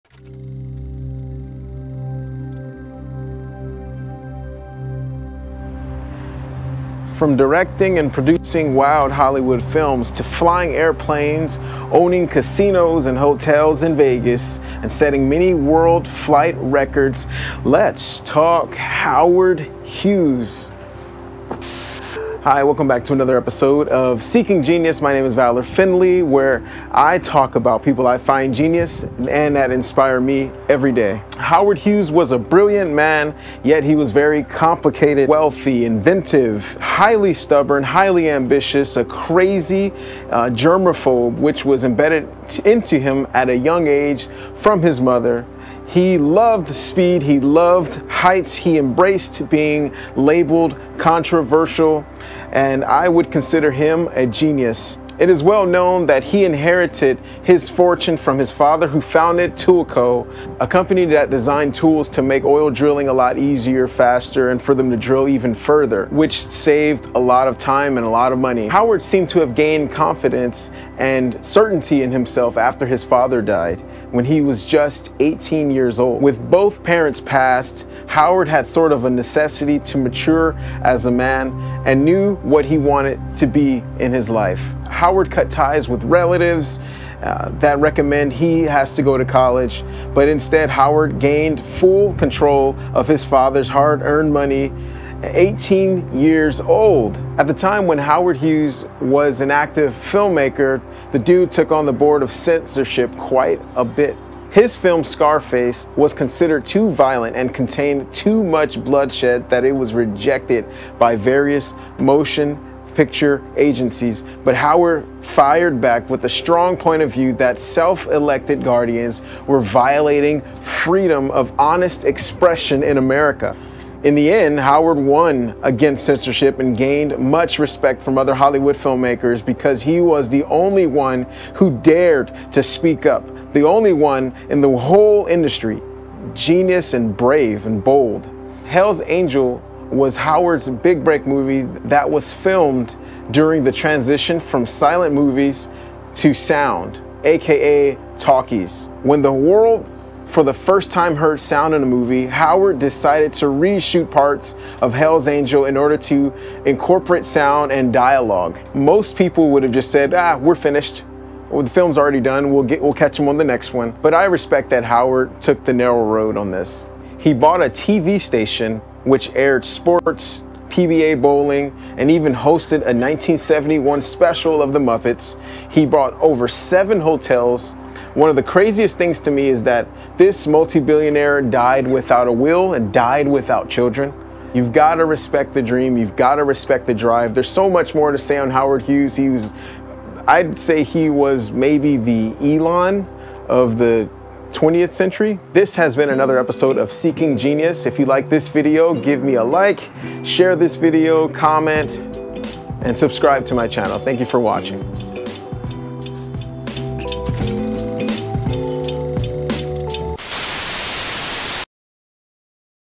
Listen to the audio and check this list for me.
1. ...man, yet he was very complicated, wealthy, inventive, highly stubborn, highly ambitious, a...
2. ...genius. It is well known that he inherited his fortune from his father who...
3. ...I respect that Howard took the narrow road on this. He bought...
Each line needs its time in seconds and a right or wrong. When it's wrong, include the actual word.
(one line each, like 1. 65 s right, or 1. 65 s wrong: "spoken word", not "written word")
1. 32 s right
2. 54 s right
3. 164 s right.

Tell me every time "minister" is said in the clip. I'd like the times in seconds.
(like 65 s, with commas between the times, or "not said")
not said.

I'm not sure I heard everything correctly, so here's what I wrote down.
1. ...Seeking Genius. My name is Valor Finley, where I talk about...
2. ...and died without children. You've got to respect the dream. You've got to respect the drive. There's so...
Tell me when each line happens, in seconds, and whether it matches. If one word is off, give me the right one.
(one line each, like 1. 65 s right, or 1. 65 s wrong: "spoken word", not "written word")
1. 24 s right
2. 182 s right.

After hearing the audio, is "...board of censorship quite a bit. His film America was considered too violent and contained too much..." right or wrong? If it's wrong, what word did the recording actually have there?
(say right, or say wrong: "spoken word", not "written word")
wrong: "Scarface", not "America".